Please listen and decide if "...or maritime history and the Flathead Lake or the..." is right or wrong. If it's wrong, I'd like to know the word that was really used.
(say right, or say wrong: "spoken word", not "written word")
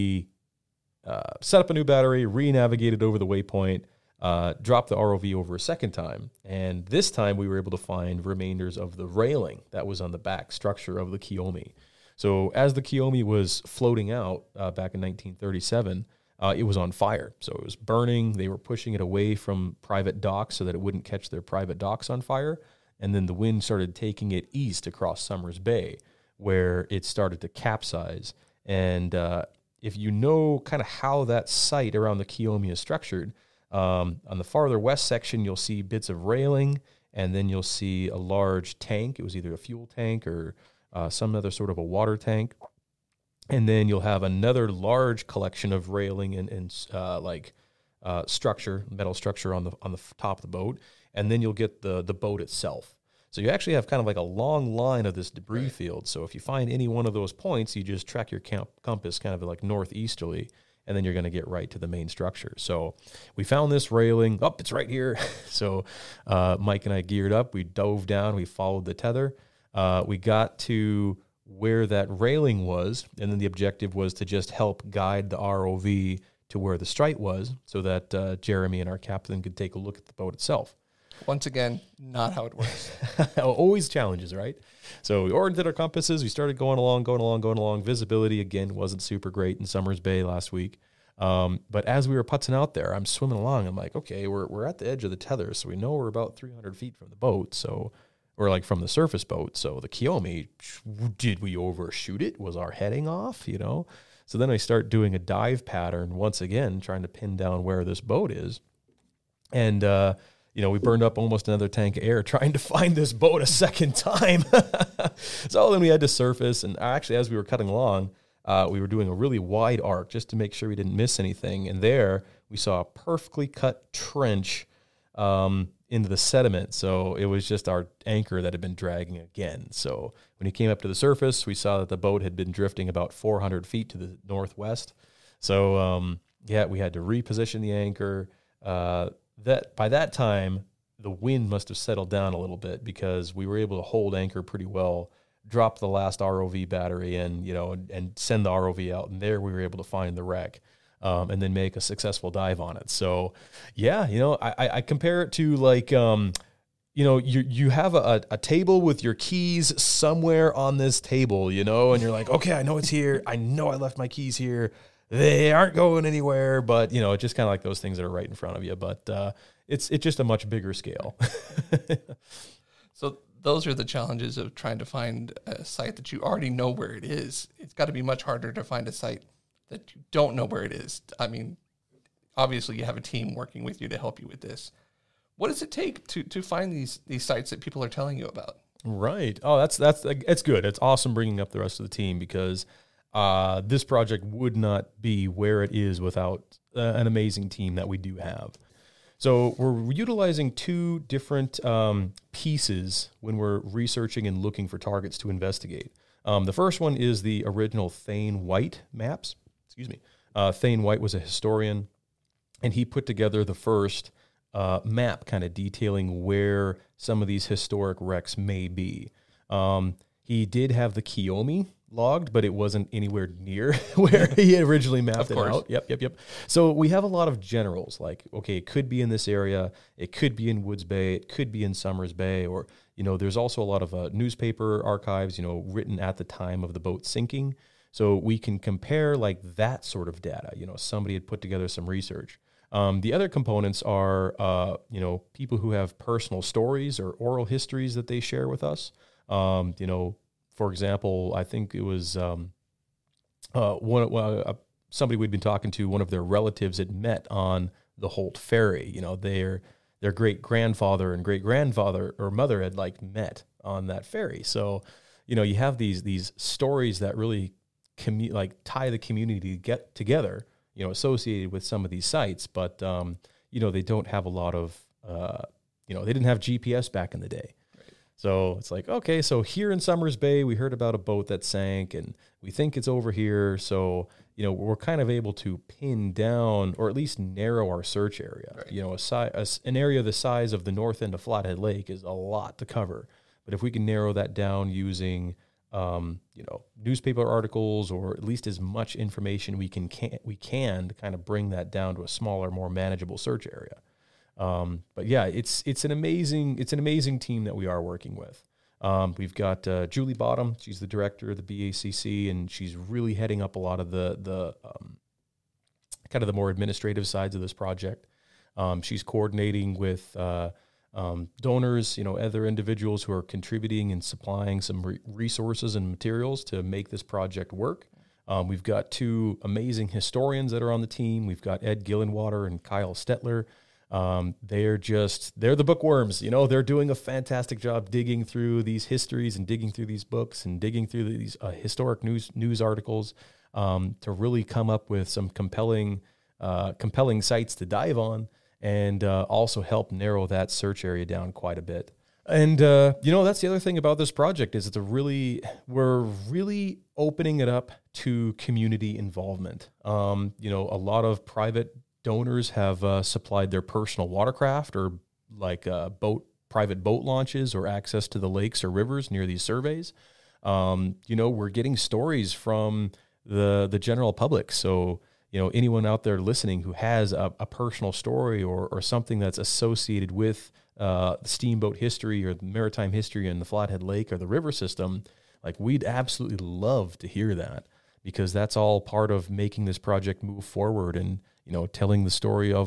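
right.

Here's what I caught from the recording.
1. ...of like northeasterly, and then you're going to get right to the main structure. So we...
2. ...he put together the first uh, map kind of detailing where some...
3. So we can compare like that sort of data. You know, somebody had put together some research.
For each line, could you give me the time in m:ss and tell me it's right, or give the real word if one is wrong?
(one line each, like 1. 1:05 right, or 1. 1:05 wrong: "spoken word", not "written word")
1. 0:59 right
2. 3:32 right
3. 3:57 right.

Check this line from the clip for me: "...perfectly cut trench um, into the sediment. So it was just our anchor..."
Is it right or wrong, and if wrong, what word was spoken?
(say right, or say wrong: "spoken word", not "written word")
right.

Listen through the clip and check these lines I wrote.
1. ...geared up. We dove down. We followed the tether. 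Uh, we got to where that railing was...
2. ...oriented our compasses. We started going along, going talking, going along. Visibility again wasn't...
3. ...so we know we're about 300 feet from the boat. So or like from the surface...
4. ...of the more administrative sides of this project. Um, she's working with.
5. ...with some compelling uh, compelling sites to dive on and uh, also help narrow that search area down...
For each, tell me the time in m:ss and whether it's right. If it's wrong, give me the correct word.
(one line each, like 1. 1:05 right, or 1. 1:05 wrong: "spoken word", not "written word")
1. 1:06 right
2. 1:25 wrong: "along", not "talking"
3. 1:35 right
4. 5:16 wrong: "coordinating", not "working"
5. 5:44 right.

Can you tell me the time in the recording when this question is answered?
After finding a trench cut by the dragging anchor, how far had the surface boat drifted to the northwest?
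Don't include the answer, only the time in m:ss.
2:13.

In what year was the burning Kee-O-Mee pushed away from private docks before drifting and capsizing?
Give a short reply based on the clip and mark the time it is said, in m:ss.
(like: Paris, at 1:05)
1937, at 0:14.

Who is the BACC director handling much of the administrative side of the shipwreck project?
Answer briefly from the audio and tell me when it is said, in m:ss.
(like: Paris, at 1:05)
Julie Bottom, at 5:09.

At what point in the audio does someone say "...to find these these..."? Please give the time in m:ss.
3:06.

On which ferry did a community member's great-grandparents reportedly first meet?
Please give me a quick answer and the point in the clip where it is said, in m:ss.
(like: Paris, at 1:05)
Holt Ferry, at 4:18.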